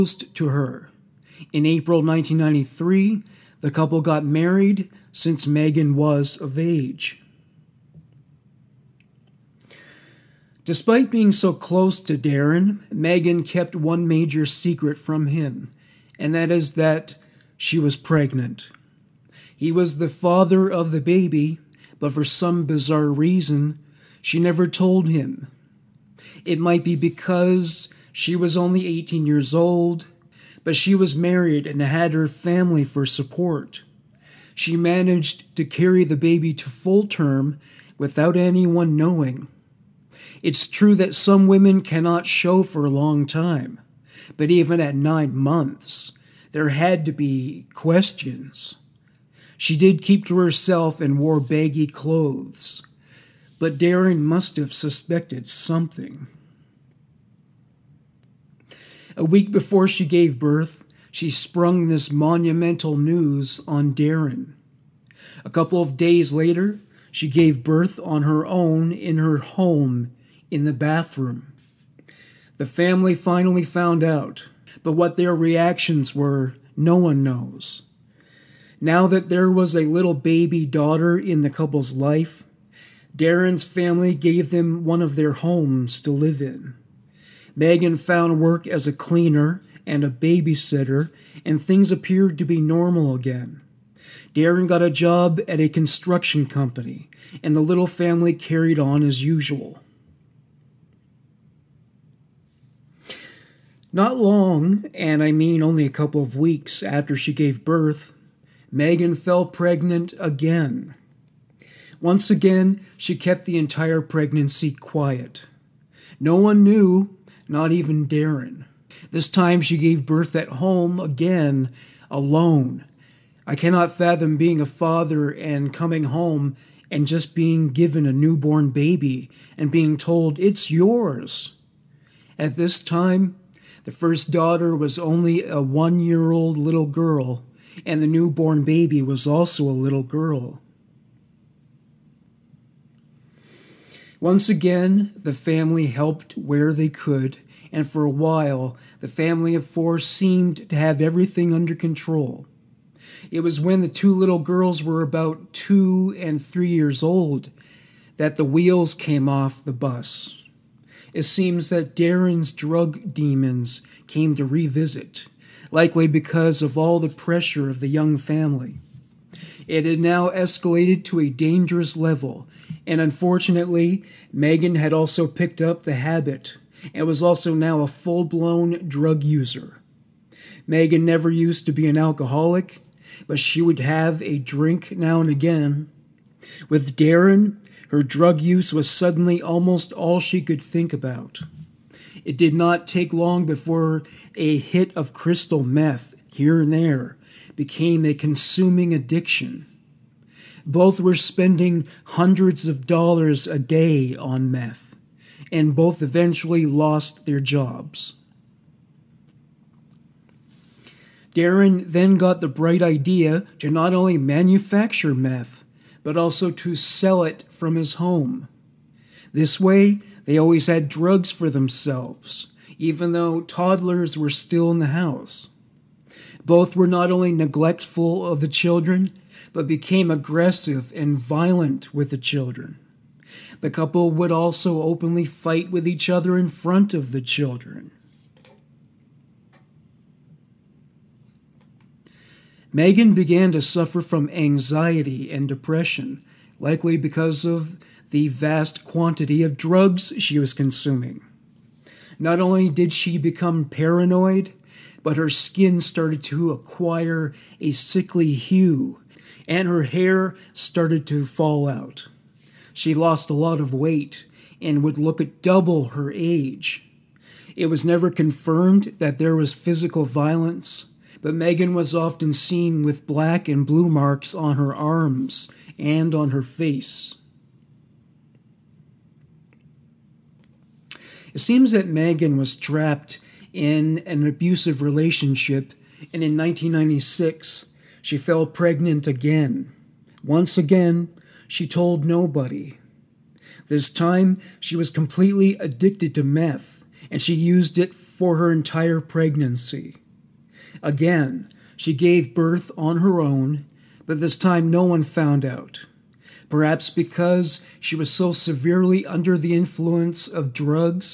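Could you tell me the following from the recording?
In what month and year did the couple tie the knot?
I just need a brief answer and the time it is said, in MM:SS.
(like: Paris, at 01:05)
April 1993, at 00:01.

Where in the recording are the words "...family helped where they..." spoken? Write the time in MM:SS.
02:25.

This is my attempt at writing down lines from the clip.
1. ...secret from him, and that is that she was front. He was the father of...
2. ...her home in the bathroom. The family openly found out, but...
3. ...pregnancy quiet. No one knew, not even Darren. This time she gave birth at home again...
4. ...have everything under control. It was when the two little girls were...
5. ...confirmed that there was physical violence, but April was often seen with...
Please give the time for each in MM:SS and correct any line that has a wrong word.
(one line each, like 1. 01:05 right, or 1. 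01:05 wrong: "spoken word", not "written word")
1. 00:14 wrong: "pregnant", not "front"
2. 01:09 wrong: "finally", not "openly"
3. 01:54 right
4. 02:30 right
5. 04:28 wrong: "Megan", not "April".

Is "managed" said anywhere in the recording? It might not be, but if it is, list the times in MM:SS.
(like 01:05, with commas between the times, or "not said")
00:34.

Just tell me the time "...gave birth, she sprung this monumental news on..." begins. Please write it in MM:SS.
01:00.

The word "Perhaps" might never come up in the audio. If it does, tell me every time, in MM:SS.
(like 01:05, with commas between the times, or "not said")
05:06.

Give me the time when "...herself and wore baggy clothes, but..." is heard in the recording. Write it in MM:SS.
00:50.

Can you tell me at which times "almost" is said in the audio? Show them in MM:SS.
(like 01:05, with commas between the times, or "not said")
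03:09.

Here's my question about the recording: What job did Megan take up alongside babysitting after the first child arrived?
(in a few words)
Cleaner.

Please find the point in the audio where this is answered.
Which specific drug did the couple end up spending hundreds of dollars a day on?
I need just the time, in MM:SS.
03:15.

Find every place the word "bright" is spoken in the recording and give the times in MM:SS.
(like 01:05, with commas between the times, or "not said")
03:32.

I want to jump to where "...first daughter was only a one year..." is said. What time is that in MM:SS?
02:13.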